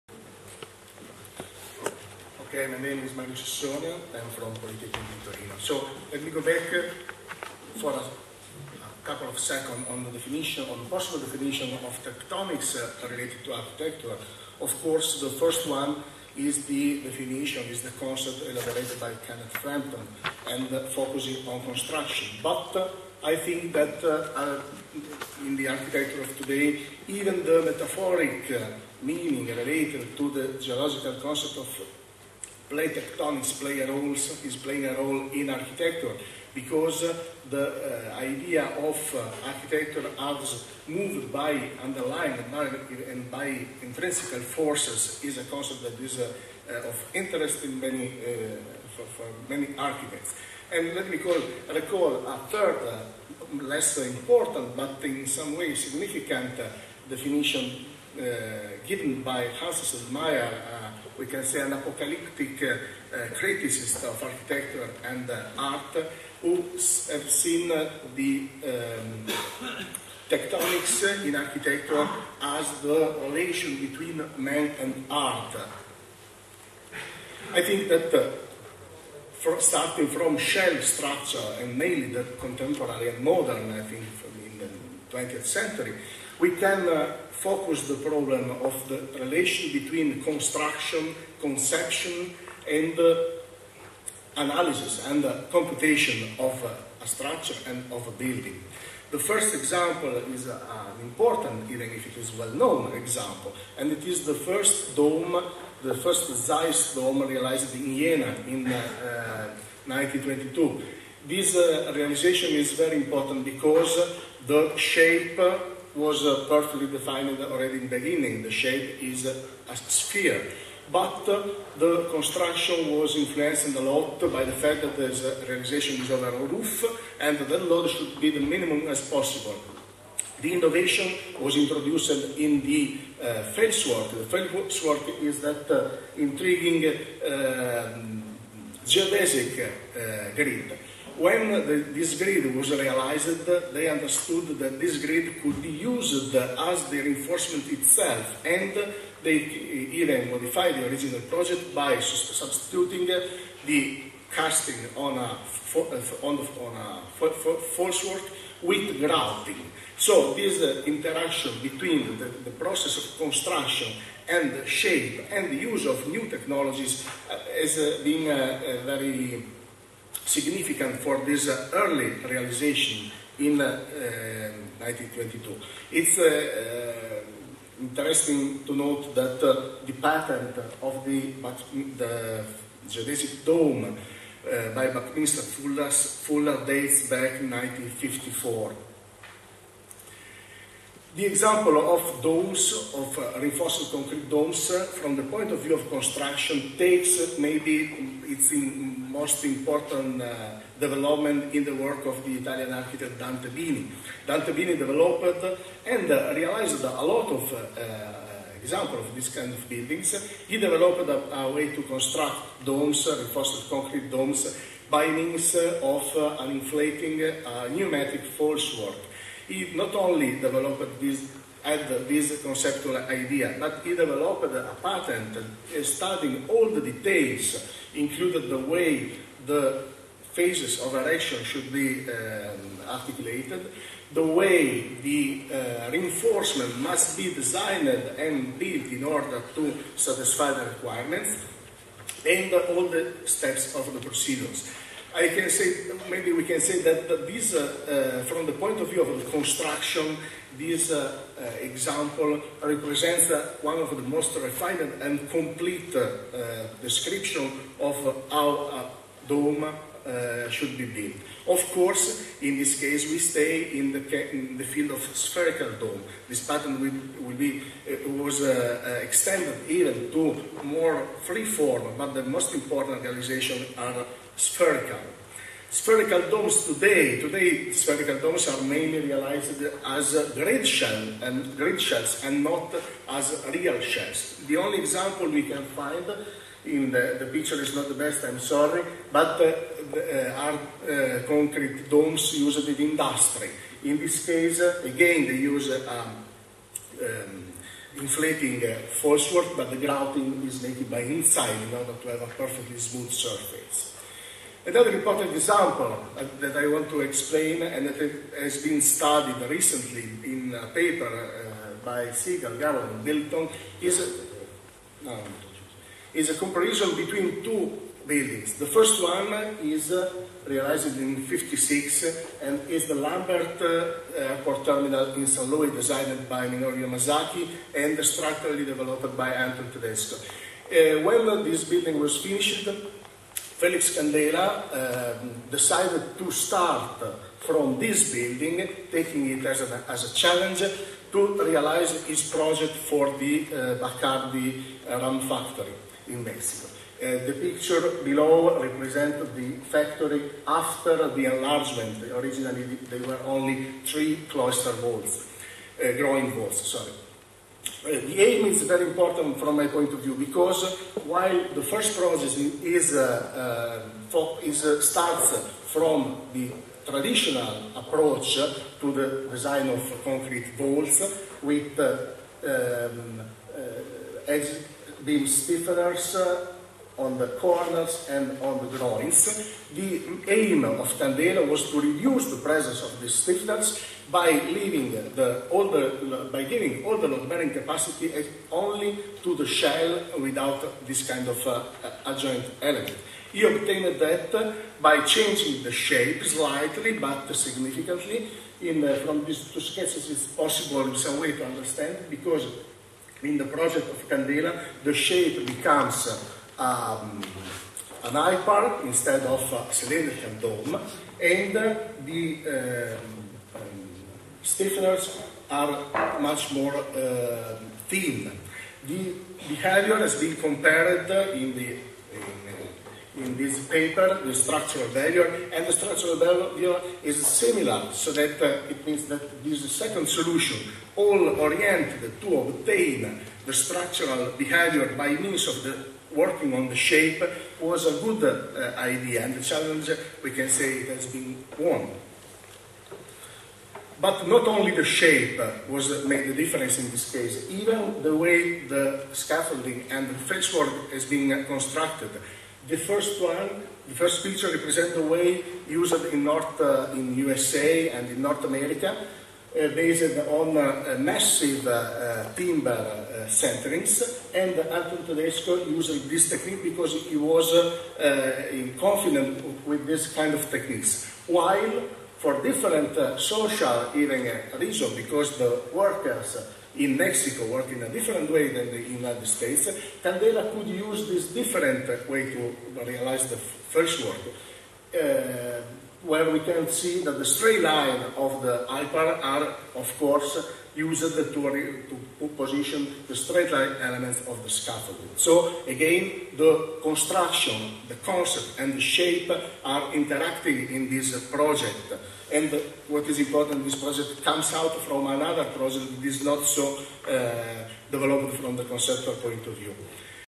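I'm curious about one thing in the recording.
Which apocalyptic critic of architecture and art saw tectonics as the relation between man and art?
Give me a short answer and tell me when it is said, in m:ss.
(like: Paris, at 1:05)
Hans Meyer, at 0:59.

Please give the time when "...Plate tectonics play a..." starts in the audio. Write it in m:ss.
0:32.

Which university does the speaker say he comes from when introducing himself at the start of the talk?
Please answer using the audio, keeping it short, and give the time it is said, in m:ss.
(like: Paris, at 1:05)
Polytechnic Torino, at 0:04.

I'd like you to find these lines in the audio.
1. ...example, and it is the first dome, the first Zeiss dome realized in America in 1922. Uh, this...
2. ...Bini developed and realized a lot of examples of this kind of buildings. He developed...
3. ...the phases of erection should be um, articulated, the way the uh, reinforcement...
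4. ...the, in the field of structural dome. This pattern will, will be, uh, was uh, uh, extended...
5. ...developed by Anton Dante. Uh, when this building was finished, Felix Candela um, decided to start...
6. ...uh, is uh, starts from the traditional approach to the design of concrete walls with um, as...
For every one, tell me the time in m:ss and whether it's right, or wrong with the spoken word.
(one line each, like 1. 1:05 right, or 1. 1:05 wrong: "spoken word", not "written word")
1. 1:42 wrong: "Jena", not "America"
2. 3:24 right
3. 3:49 right
4. 4:23 wrong: "spherical", not "structural"
5. 5:28 wrong: "Tedesko", not "Dante"
6. 6:04 right.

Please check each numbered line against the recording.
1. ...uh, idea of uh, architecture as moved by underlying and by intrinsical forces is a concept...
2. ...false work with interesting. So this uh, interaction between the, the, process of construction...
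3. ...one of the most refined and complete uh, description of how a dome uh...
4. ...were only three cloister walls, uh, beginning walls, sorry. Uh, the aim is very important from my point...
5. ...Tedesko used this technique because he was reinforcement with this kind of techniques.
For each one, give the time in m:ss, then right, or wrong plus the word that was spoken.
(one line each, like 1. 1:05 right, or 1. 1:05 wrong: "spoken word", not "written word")
1. 0:37 right
2. 2:37 wrong: "grouting", not "interesting"
3. 4:13 right
4. 5:53 wrong: "growing", not "beginning"
5. 7:45 wrong: "confident", not "reinforcement".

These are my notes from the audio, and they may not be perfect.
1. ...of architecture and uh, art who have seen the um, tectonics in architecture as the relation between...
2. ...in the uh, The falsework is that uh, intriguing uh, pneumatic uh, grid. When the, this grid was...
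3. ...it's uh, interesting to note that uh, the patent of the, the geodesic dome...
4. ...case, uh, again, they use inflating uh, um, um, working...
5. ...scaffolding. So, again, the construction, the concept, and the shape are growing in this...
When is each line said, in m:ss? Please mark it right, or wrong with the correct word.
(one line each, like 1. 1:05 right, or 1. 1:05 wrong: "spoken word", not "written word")
1. 1:04 right
2. 2:12 wrong: "geodesic", not "pneumatic"
3. 2:55 right
4. 4:54 wrong: "inflating", not "working"
5. 8:14 wrong: "interacting", not "growing".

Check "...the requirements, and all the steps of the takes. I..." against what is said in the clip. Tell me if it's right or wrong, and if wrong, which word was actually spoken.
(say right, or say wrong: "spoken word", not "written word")
wrong: "procedures", not "takes".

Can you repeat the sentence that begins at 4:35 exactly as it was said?
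Spherical domes today, today spherical domes are mainly realized as grid shell and grid shells and not as real shells.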